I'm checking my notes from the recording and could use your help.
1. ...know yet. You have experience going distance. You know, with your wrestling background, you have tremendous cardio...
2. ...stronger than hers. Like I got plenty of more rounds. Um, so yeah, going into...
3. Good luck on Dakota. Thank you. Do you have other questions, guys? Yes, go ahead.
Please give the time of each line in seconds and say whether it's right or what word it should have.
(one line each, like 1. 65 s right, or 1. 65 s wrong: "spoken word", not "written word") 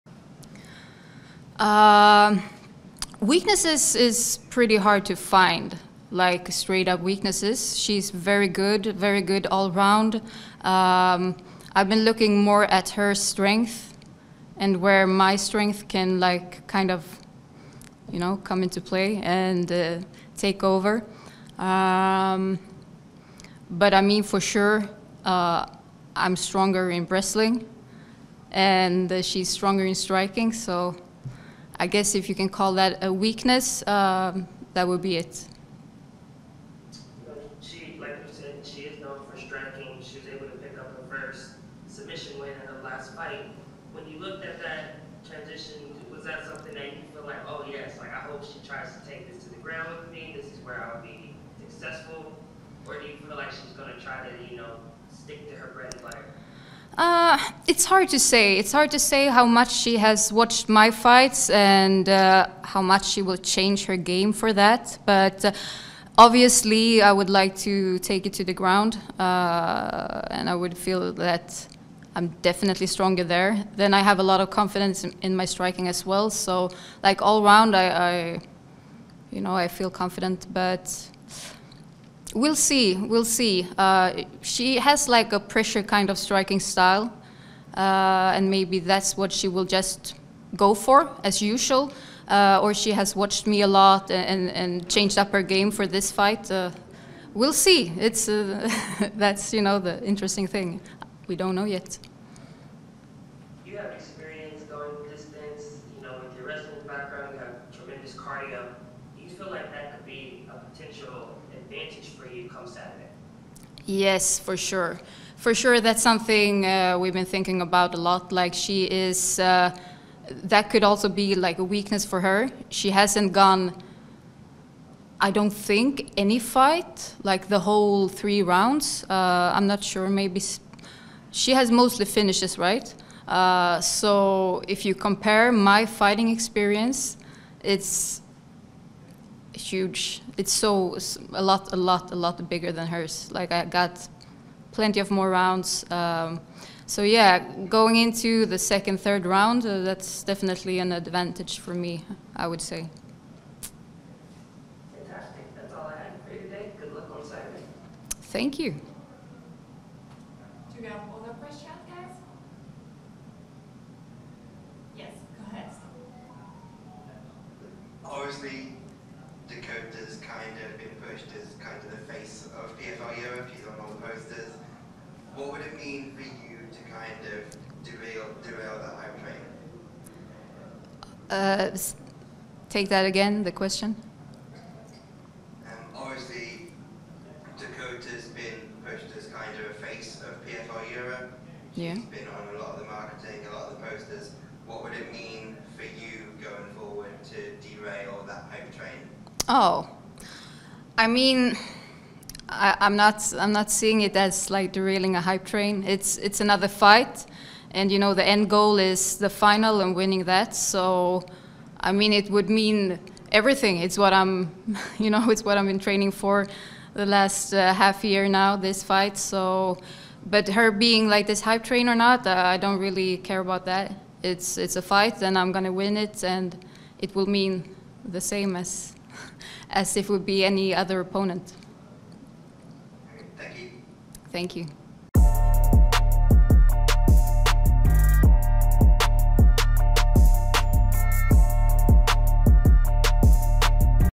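1. 101 s right
2. 142 s wrong: "bigger", not "stronger"
3. 156 s wrong: "Saturday", not "Dakota".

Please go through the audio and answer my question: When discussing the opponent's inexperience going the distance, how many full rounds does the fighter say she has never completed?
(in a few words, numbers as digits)
3.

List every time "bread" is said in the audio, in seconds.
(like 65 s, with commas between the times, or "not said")
55 s.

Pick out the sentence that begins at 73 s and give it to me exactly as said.
Then I have a lot of confidence in, in my striking as well.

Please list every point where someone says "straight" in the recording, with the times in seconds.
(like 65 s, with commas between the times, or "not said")
6 s.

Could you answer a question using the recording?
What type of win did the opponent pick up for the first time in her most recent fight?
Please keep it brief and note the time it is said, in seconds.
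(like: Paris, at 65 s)
Submission, at 41 s.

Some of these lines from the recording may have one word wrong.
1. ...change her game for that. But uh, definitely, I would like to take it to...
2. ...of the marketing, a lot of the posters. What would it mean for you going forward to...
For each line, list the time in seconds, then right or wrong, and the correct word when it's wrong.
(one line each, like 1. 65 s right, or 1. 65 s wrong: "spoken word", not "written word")
1. 63 s wrong: "obviously", not "definitely"
2. 192 s right.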